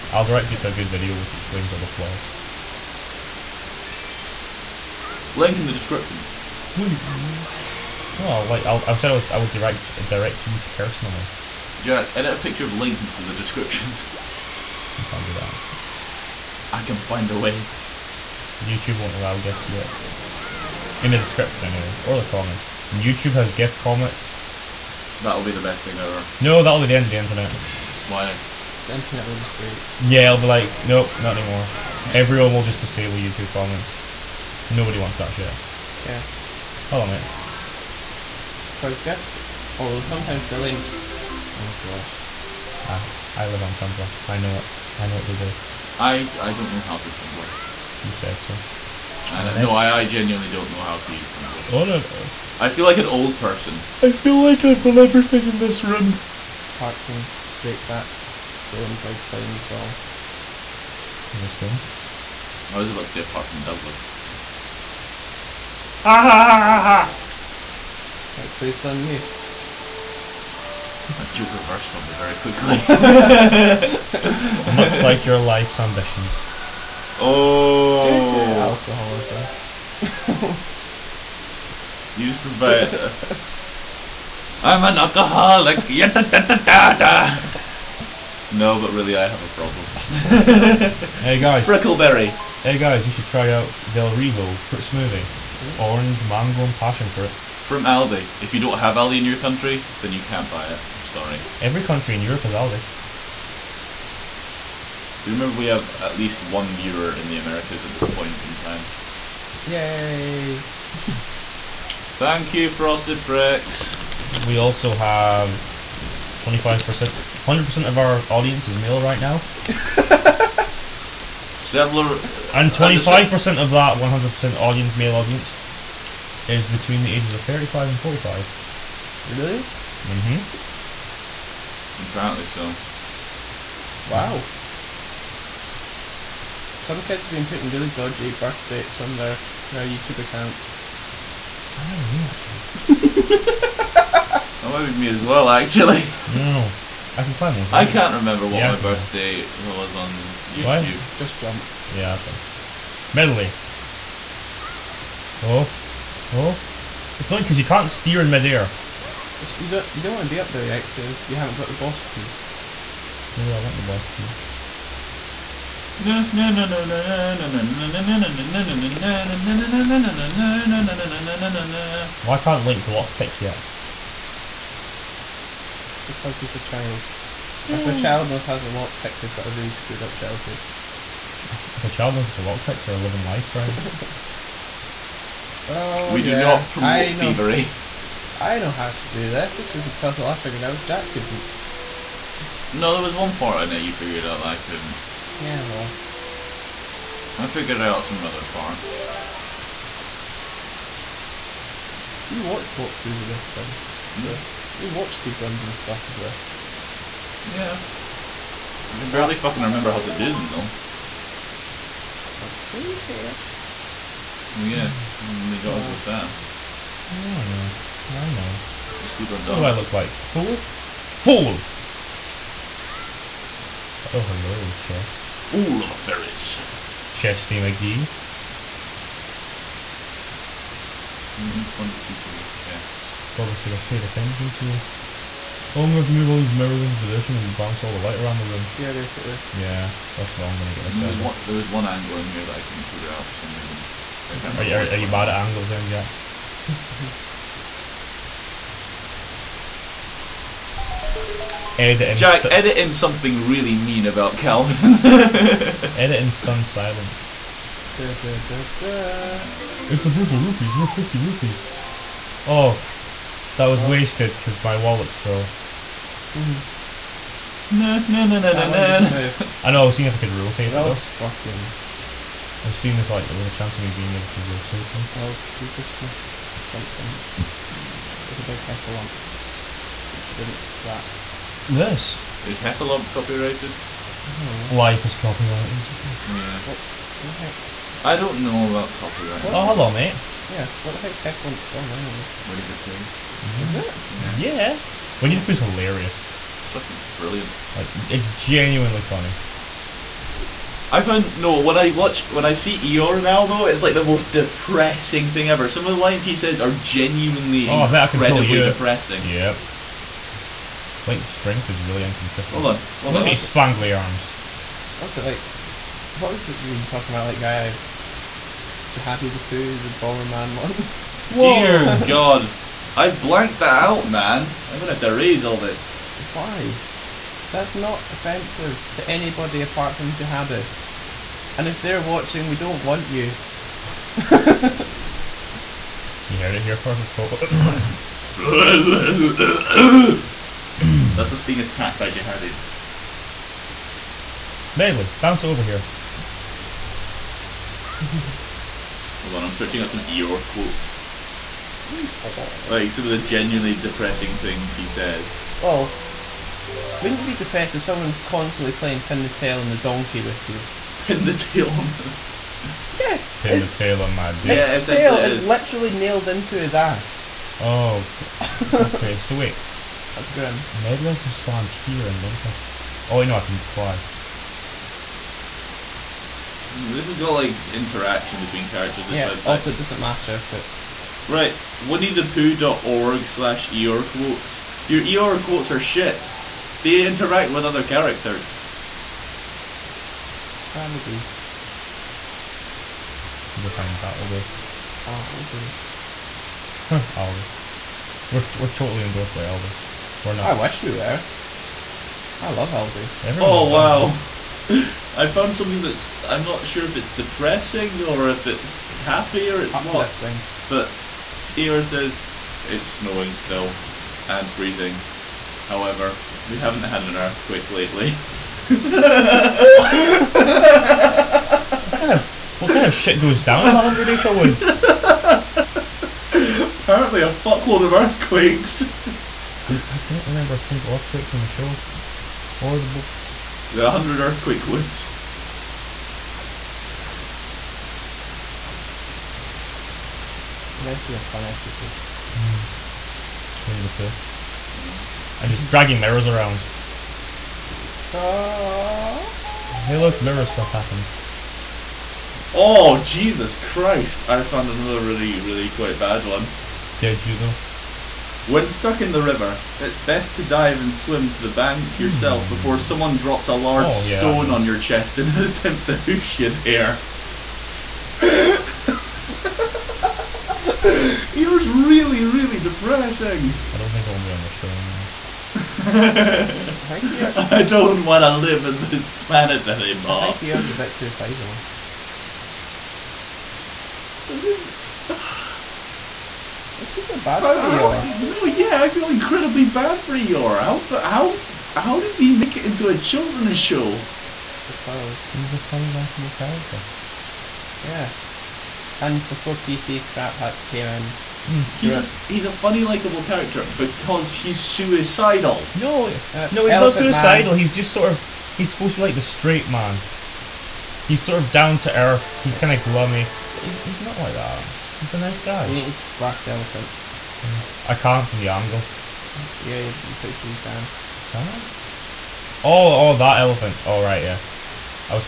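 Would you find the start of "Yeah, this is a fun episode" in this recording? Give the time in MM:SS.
07:20.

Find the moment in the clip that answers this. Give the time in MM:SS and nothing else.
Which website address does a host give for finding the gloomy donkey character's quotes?
06:21.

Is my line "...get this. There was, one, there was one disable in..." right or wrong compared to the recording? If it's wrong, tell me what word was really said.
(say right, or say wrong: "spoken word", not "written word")
wrong: "angle", not "disable".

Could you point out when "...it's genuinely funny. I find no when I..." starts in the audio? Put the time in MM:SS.
04:58.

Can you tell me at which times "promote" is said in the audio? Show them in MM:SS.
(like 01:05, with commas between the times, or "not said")
03:06.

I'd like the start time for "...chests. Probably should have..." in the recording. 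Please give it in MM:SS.
03:52.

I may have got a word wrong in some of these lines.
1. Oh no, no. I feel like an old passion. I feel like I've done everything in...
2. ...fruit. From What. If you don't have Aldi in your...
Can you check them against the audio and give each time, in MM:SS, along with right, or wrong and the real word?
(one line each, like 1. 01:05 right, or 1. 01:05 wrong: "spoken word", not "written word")
1. 00:51 wrong: "person", not "passion"
2. 01:37 wrong: "Aldi", not "What".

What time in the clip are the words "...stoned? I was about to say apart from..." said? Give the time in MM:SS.
01:01.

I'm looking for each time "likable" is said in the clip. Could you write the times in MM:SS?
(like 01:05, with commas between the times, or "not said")
08:15, 08:22.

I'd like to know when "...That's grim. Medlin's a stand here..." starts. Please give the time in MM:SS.
06:10.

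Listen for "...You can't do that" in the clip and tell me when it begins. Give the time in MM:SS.
00:14.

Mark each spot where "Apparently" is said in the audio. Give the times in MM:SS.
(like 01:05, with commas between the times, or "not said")
02:12, 07:06.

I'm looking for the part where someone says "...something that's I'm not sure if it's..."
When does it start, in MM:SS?
06:45.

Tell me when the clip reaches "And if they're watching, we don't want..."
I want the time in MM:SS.
05:31.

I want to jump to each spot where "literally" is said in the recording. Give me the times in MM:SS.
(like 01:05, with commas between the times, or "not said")
06:05.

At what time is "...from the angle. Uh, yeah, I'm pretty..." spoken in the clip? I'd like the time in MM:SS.
08:38.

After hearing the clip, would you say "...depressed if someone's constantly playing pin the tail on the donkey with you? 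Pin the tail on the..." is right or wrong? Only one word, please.
right.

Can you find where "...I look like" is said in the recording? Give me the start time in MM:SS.
03:39.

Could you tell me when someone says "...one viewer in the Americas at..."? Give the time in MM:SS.
01:46.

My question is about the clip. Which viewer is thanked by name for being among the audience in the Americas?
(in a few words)
Frosted Fricks.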